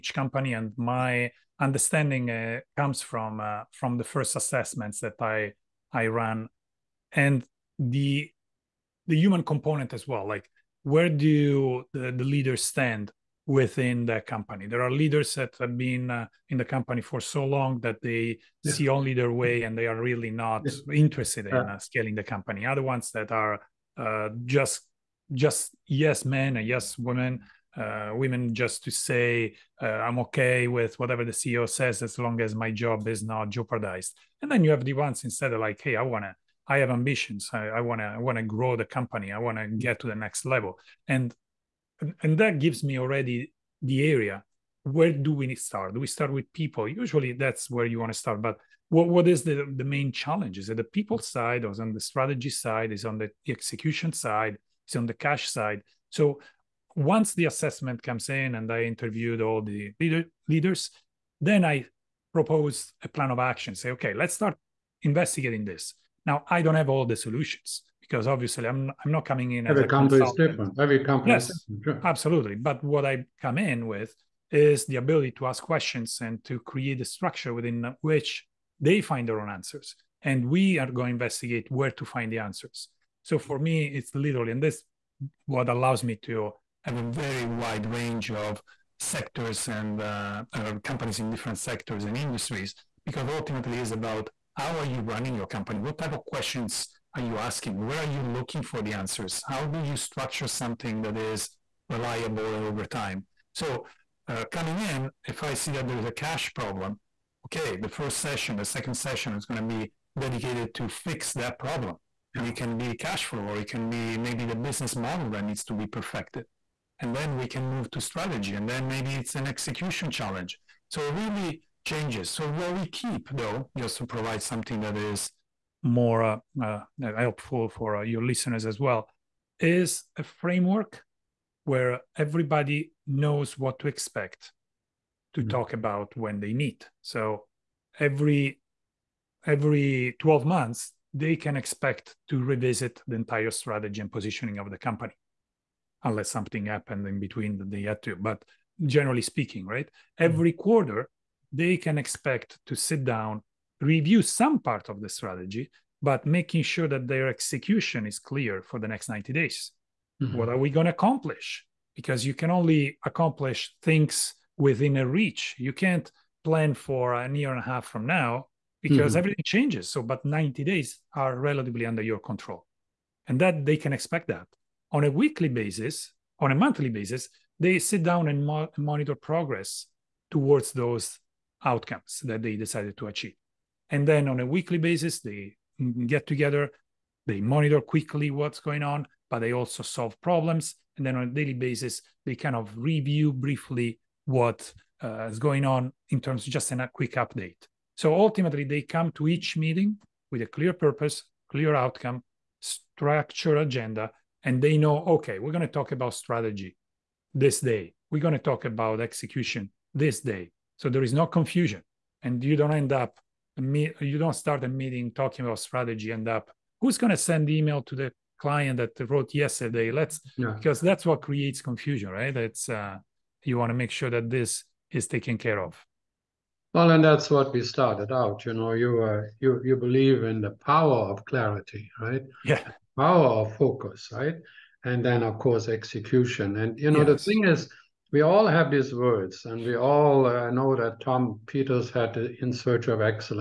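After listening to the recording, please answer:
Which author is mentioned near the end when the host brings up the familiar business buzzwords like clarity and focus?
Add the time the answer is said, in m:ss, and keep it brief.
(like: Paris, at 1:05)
Tom Peters, at 4:01.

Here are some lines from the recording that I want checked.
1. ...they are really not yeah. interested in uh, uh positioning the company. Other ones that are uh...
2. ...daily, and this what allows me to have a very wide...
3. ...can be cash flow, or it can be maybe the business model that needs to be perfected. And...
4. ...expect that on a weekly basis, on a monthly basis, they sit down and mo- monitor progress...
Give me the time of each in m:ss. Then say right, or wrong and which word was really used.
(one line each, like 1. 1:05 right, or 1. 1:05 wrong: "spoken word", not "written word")
1. 0:19 wrong: "scaling", not "positioning"
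2. 1:24 wrong: "literally", not "daily"
3. 1:52 right
4. 2:53 right.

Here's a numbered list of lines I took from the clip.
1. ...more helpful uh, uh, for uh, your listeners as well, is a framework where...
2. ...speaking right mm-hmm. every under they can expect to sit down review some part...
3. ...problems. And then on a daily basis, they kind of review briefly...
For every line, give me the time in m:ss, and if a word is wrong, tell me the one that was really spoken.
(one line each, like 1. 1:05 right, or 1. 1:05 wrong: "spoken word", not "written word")
1. 2:05 right
2. 2:29 wrong: "quarter", not "under"
3. 3:10 right.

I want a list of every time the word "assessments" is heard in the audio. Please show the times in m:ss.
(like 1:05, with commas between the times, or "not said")
0:04, 0:57.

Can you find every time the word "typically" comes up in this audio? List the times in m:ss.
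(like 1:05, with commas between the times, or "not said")
not said.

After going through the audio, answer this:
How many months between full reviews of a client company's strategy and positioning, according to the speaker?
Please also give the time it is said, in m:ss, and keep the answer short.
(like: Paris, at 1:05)
12, at 2:20.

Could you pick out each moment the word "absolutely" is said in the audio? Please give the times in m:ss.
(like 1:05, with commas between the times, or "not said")
1:12.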